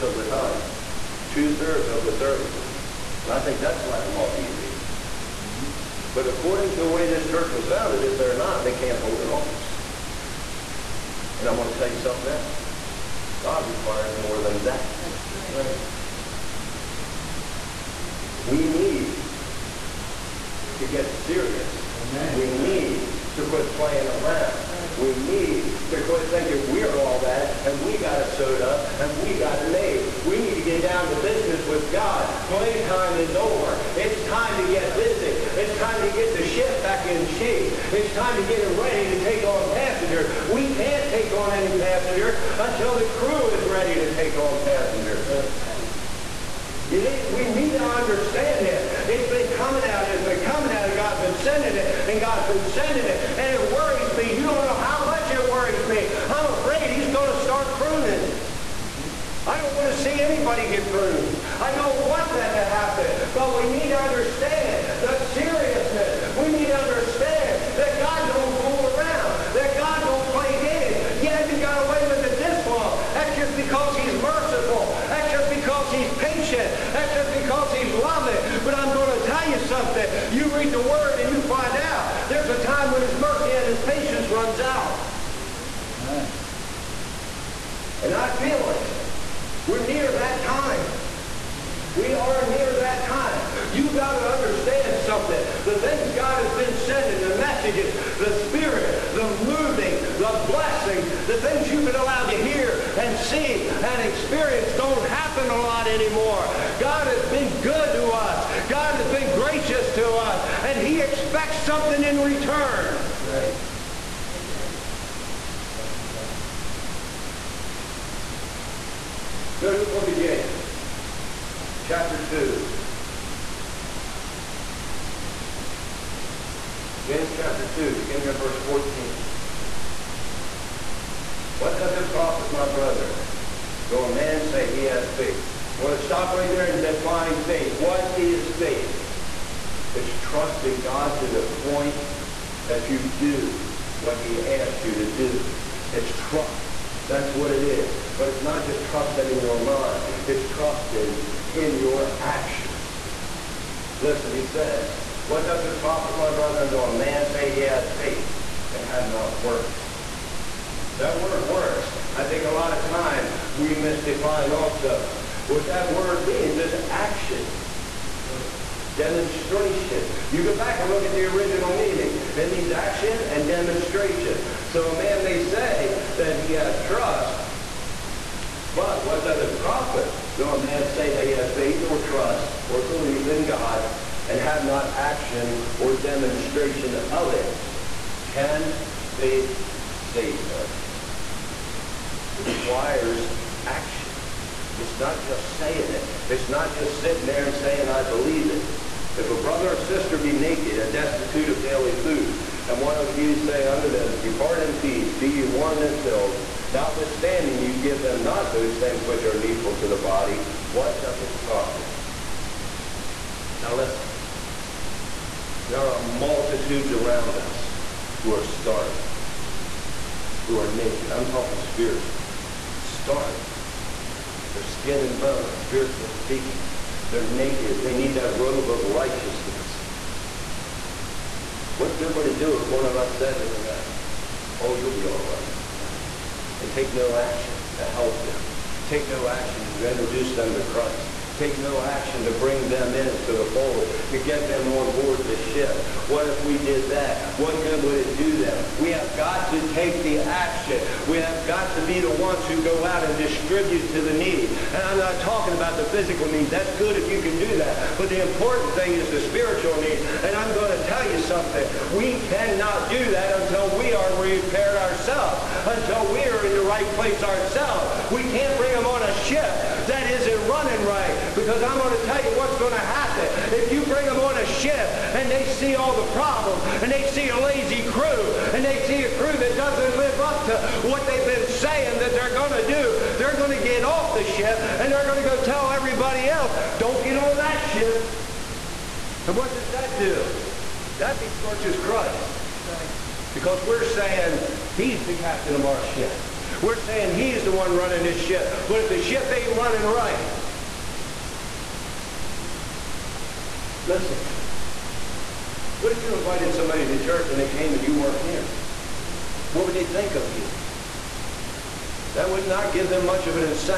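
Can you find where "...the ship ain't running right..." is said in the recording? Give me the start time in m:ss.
4:58.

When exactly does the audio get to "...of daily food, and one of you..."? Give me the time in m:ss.
3:21.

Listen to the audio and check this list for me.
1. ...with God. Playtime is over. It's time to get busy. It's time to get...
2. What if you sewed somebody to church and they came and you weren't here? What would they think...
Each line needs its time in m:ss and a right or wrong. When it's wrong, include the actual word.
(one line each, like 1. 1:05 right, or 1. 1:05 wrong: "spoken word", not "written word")
1. 0:31 right
2. 5:05 wrong: "invited", not "sewed".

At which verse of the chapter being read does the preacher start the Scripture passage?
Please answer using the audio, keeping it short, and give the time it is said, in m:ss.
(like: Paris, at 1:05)
14, at 2:08.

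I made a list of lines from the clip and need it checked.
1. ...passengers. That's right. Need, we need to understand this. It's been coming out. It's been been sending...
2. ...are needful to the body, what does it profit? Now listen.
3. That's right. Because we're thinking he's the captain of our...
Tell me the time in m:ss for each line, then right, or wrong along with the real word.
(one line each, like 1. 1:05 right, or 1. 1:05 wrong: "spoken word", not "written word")
1. 0:44 right
2. 3:29 right
3. 4:52 wrong: "saying", not "thinking".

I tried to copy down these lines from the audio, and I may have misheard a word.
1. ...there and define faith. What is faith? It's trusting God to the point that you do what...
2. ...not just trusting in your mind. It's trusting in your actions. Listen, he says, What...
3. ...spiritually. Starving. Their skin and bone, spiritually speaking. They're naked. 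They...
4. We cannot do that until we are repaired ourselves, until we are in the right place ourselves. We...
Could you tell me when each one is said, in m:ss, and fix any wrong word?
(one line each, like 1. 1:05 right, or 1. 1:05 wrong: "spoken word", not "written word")
1. 2:16 right
2. 2:28 right
3. 3:41 right
4. 4:21 right.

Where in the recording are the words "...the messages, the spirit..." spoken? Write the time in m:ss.
1:37.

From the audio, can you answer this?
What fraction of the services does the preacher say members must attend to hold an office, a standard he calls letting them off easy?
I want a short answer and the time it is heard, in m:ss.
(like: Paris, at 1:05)
two-thirds, at 0:01.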